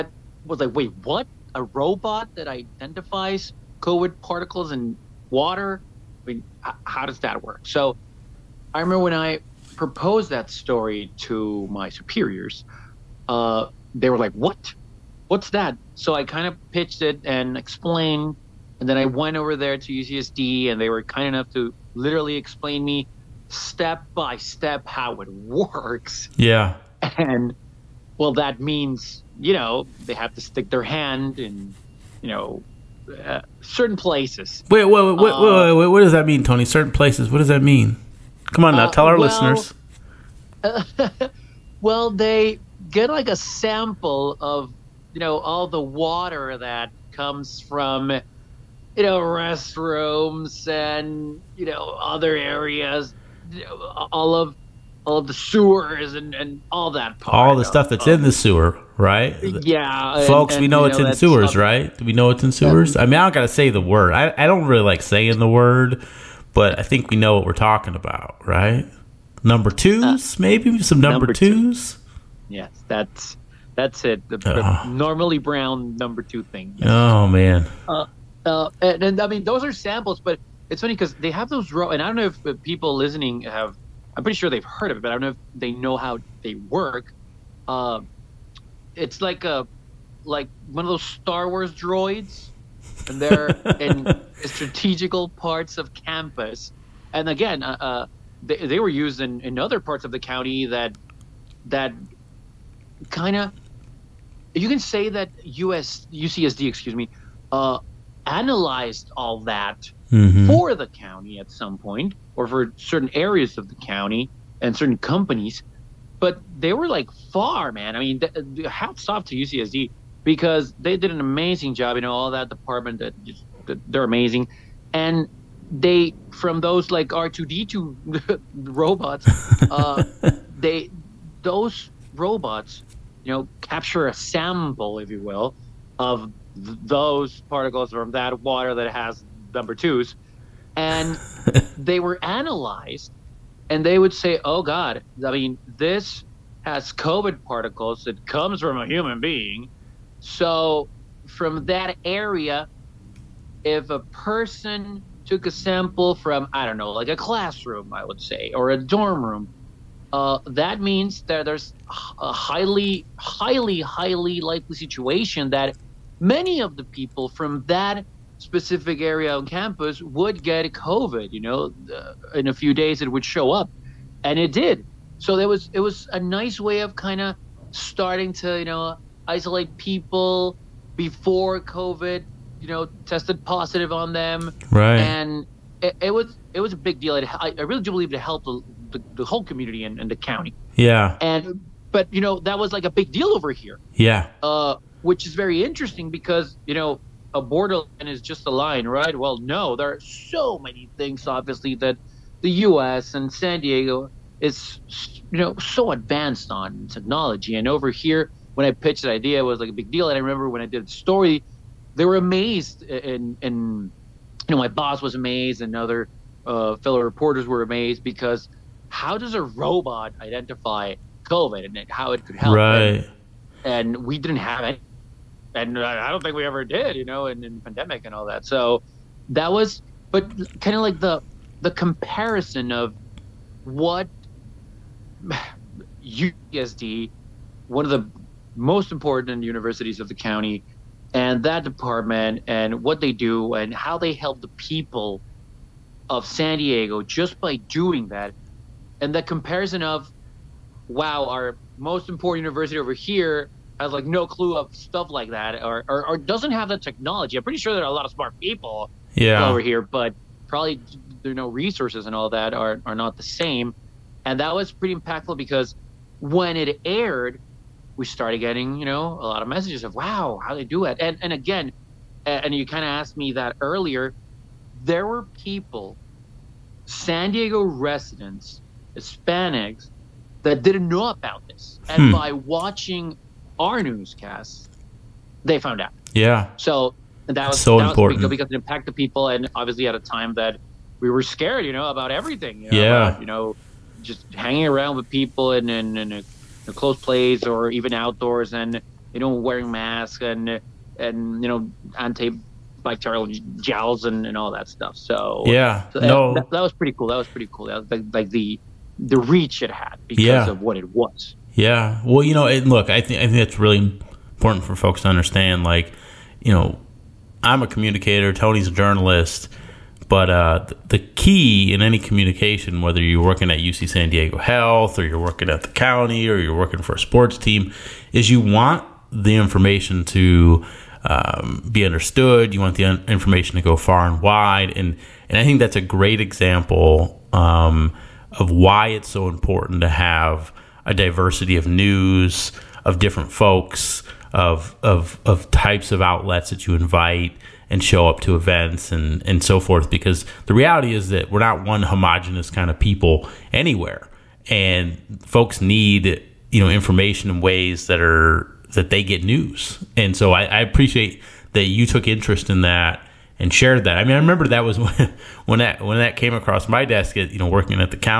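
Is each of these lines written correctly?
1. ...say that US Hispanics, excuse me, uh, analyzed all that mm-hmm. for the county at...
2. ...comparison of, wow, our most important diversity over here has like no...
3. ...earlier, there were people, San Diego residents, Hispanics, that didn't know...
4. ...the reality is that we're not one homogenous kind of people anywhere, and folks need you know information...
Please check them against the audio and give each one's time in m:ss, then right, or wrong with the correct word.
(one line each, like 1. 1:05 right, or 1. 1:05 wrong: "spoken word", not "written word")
1. 1:44 wrong: "UCSD", not "Hispanics"
2. 4:09 wrong: "university", not "diversity"
3. 4:33 right
4. 5:50 right.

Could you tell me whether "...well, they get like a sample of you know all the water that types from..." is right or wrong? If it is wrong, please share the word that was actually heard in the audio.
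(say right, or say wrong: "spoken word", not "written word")
wrong: "comes", not "types".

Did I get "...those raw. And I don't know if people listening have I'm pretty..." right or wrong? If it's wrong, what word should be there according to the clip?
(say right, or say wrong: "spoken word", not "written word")
right.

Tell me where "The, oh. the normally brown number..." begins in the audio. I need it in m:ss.
1:14.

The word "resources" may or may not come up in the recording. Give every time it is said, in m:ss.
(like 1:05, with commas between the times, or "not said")
4:21.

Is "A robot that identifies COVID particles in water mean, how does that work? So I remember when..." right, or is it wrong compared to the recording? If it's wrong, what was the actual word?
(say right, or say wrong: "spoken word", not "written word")
right.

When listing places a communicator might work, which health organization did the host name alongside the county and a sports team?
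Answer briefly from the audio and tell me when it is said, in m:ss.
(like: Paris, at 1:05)
UC San Diego Health, at 5:23.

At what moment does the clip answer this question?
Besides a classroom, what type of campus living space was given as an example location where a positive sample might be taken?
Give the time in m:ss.
2:38.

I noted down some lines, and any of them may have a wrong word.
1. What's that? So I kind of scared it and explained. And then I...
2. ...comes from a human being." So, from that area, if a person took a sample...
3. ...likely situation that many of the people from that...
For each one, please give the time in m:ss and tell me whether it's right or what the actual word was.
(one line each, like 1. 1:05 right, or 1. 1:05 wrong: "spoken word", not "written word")
1. 0:15 wrong: "pitched", not "scared"
2. 2:28 right
3. 2:44 right.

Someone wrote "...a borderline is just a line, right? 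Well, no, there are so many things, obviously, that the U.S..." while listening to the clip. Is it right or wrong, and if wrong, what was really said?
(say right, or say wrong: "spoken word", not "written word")
right.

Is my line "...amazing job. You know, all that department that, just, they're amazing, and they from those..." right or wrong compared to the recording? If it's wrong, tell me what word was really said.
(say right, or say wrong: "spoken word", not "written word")
right.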